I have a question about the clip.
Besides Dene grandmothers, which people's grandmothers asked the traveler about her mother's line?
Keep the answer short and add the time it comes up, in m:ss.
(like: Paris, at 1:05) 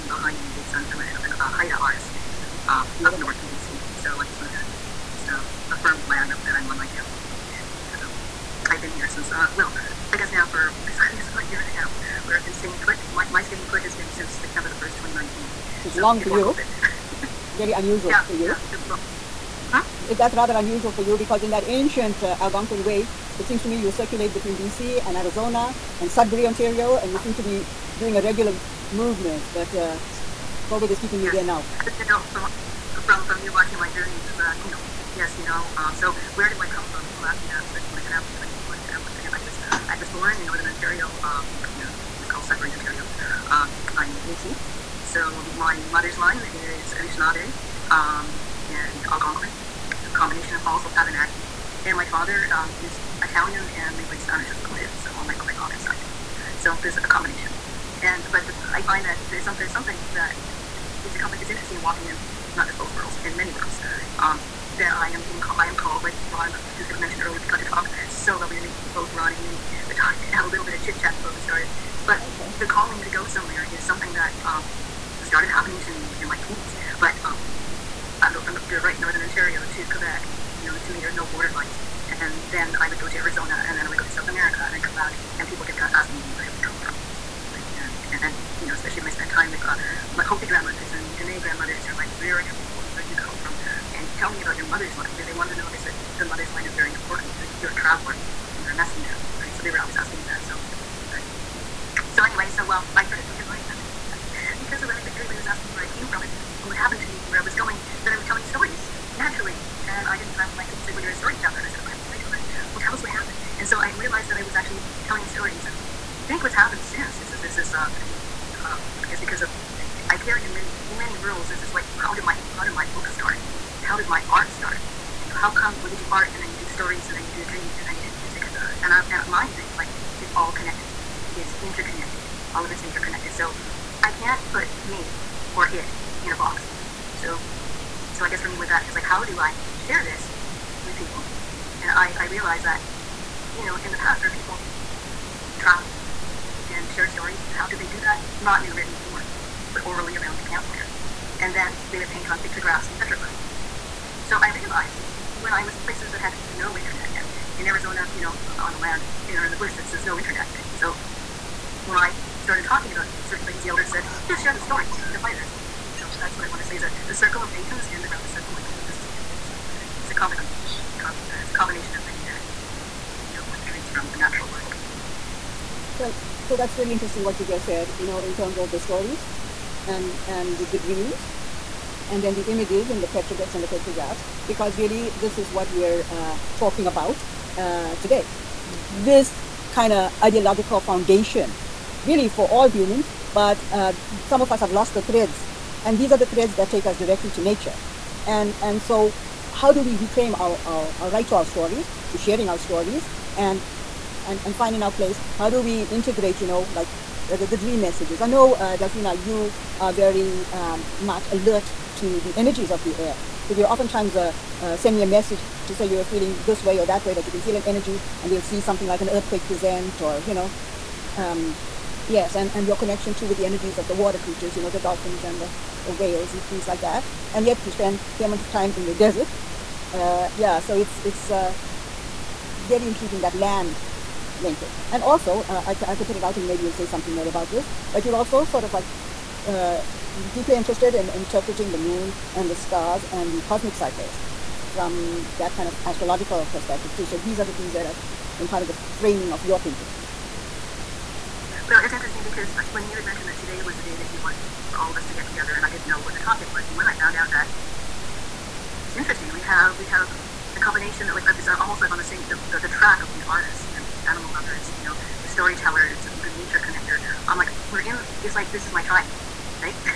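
Hopi, at 1:30.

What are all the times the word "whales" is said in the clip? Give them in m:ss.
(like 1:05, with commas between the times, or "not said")
3:45.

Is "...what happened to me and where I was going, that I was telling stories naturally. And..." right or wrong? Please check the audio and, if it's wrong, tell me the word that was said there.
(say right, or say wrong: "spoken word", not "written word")
right.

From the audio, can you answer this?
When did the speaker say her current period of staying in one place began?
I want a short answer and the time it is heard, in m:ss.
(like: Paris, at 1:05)
September 1, 2019, at 0:14.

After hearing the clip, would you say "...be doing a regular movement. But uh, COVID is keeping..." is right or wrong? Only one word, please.
right.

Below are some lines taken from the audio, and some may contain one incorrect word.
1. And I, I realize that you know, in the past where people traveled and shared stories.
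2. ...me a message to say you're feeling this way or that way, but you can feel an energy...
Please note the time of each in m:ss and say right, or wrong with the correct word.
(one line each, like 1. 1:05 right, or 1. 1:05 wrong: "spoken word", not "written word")
1. 2:21 right
2. 3:34 right.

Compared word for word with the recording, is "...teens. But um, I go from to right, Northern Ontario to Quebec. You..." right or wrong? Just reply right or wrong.
right.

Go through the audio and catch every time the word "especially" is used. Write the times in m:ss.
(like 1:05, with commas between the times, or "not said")
0:37, 1:28.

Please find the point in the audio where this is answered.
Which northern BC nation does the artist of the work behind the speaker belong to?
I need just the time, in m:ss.
0:01.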